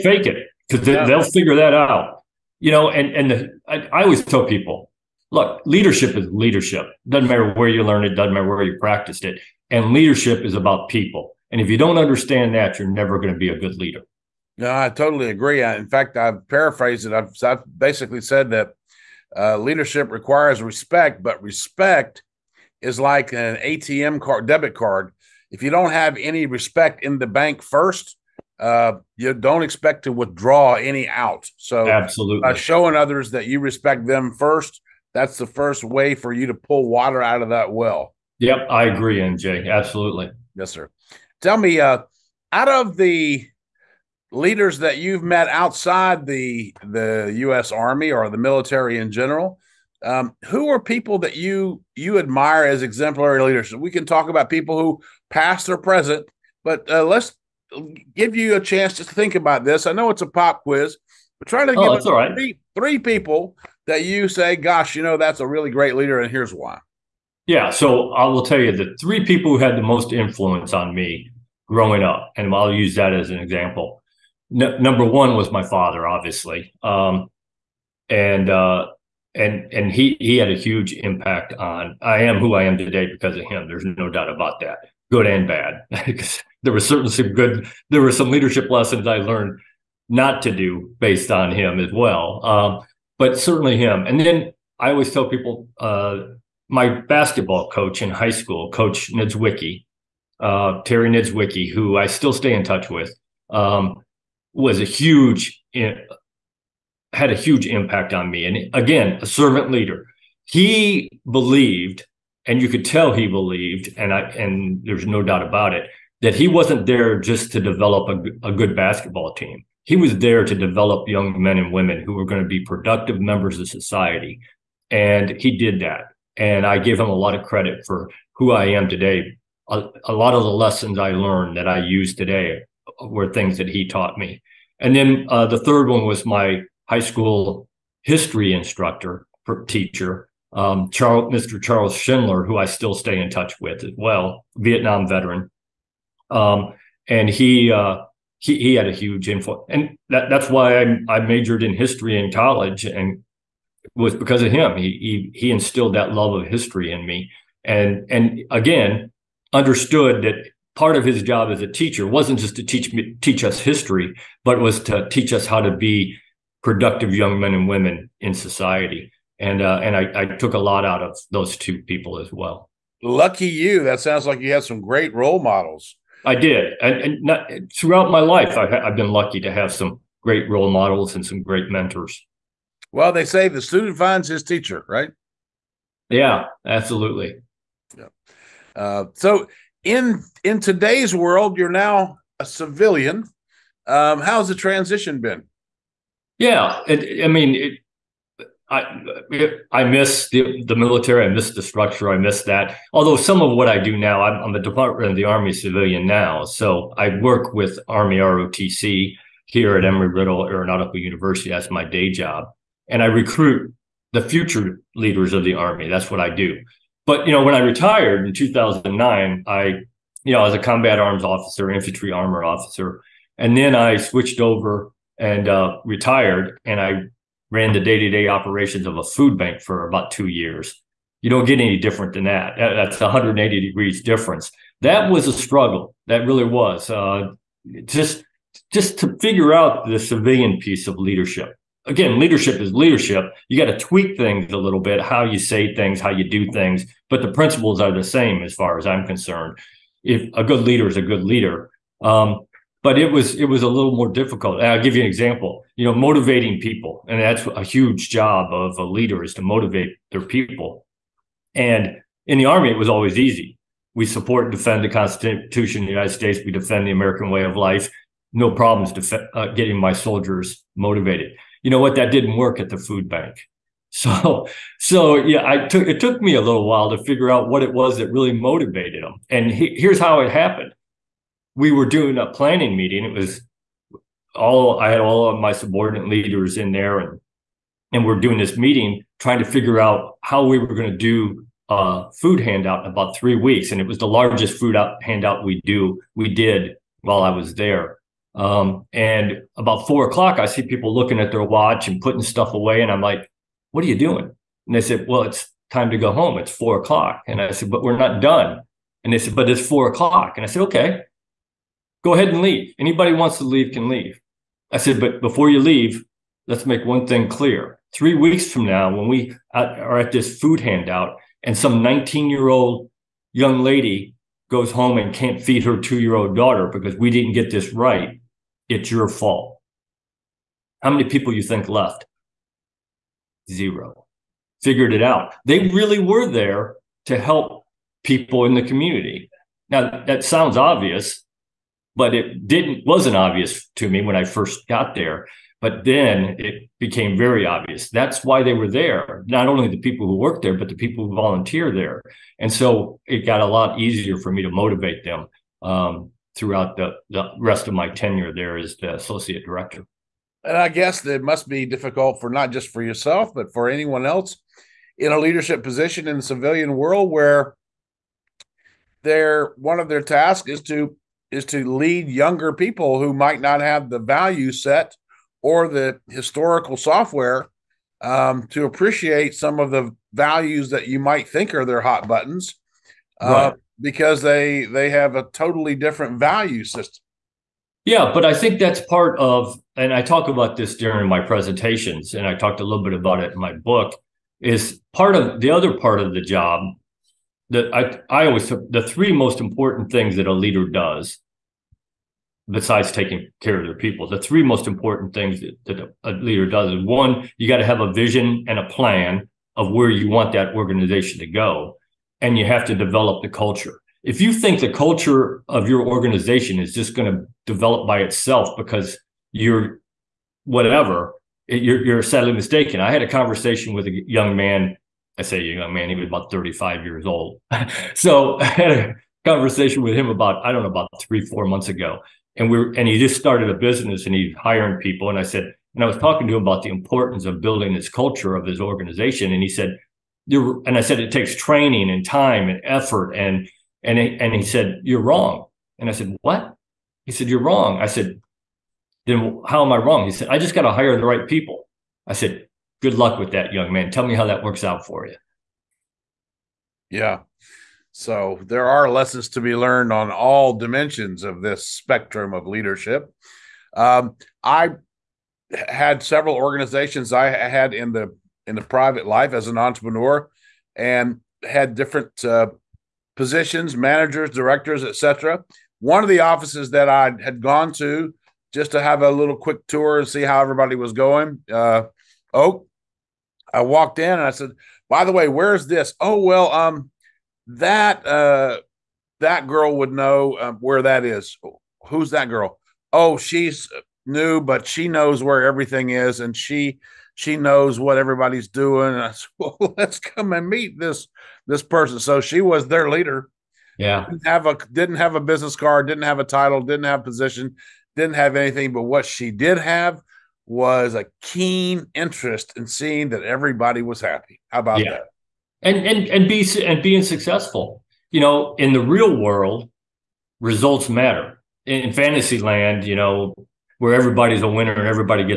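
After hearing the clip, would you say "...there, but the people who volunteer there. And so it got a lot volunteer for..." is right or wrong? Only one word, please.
wrong.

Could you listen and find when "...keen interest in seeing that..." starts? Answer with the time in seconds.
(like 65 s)
511 s.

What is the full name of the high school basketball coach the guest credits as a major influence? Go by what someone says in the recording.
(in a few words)
Terry Nidzwicki.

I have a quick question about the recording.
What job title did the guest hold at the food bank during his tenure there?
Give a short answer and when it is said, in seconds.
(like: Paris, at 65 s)
associate director, at 358 s.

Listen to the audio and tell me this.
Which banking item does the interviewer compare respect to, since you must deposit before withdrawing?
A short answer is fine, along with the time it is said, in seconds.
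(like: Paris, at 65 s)
ATM card, at 23 s.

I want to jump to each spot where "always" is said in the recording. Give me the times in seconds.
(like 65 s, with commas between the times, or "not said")
4 s, 94 s, 262 s, 398 s.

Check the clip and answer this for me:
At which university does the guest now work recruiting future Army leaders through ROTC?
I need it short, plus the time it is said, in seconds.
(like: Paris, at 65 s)
Embry-Riddle Aeronautical University, at 209 s.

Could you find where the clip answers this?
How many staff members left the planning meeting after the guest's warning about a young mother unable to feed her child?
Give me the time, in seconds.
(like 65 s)
333 s.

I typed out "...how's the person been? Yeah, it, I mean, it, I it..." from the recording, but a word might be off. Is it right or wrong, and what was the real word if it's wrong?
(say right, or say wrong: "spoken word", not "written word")
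wrong: "transition", not "person".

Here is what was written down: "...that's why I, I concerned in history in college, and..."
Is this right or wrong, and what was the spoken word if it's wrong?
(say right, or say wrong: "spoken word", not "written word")
wrong: "majored", not "concerned".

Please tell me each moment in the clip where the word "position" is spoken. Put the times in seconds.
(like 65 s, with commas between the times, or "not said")
365 s, 473 s, 507 s.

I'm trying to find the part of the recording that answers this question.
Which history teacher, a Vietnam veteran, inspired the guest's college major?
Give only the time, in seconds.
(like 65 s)
141 s.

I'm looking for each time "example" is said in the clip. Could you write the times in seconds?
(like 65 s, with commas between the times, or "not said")
73 s, 255 s.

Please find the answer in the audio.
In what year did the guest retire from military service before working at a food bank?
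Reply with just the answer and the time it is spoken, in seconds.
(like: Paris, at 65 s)
2009, at 218 s.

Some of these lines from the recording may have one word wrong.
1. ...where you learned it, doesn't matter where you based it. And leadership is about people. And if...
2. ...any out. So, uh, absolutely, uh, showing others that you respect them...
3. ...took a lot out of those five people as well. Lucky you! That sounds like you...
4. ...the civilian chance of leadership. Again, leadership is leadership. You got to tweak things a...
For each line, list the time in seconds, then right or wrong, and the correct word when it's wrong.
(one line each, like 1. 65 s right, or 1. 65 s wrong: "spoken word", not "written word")
1. 7 s wrong: "practiced", not "based"
2. 30 s right
3. 170 s wrong: "two", not "five"
4. 239 s wrong: "piece", not "chance".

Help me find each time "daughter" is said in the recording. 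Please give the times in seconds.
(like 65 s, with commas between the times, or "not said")
326 s.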